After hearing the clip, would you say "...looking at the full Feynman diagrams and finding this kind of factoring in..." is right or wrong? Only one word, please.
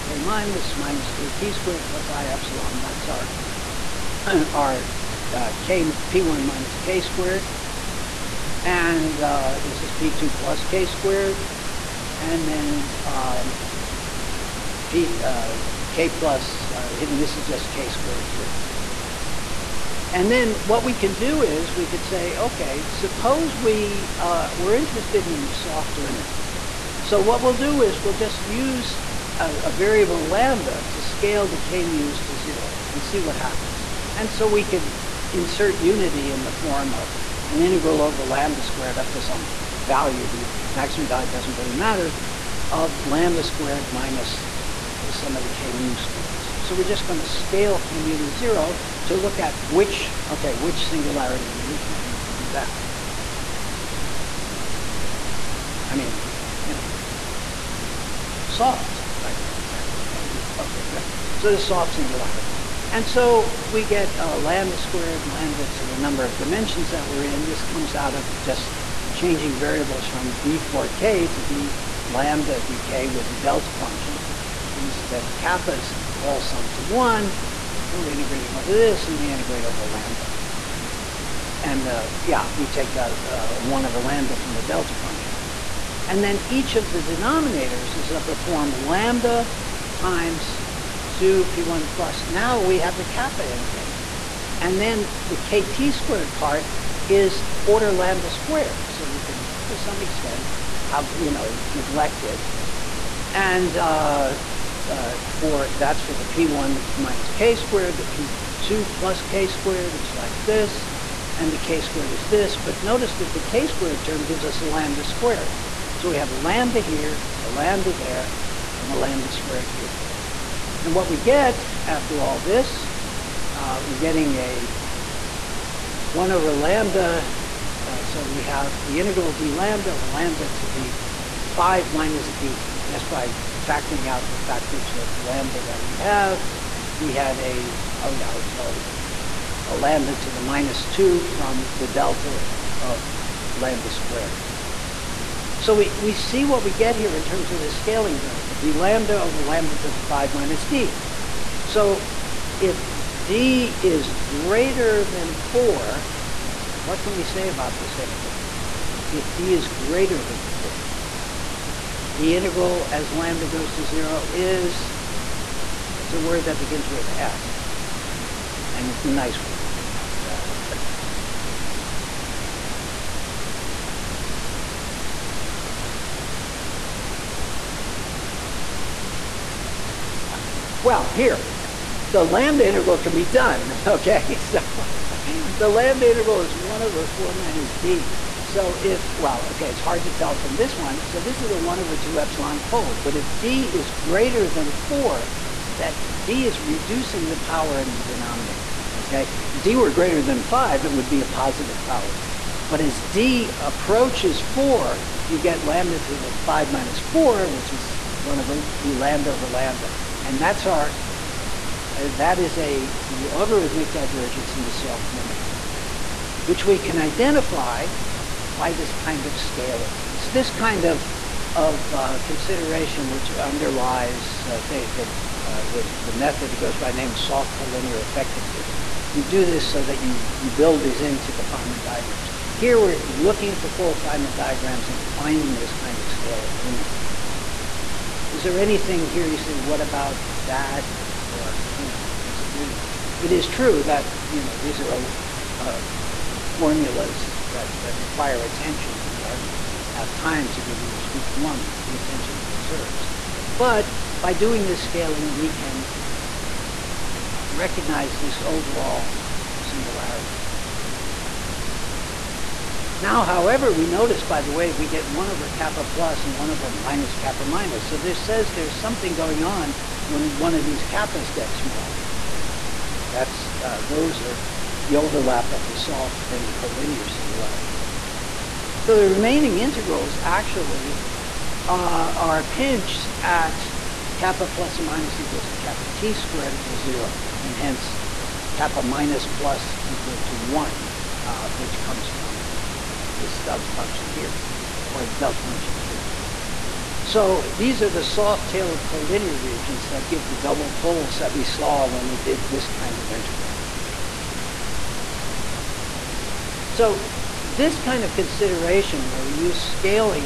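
wrong.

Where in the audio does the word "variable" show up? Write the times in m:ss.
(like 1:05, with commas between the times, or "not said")
0:29, 1:09, 2:28.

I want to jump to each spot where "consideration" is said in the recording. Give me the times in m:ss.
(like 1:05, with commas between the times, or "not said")
3:42, 5:08.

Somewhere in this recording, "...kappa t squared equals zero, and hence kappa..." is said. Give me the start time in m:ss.
4:45.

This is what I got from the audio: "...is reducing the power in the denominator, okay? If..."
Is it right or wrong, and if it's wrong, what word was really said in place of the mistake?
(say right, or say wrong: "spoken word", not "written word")
right.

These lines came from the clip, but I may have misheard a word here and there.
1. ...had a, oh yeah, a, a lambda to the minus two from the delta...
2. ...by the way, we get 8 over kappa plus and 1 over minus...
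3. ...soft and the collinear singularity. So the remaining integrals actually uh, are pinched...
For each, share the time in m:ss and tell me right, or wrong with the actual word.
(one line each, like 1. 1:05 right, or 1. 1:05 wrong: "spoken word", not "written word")
1. 2:17 right
2. 4:24 wrong: "1", not "8"
3. 4:35 right.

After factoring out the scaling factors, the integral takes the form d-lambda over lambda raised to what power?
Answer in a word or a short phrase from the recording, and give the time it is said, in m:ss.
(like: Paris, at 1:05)
5 minus d, at 2:10.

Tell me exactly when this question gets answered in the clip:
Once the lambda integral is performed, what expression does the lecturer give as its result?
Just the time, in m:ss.
3:06.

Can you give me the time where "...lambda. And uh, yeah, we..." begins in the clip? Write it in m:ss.
1:19.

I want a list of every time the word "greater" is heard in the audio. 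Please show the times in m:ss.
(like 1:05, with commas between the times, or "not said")
2:34, 2:39, 3:13, 3:19.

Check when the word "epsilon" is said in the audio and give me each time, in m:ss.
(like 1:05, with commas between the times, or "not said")
0:02, 3:12.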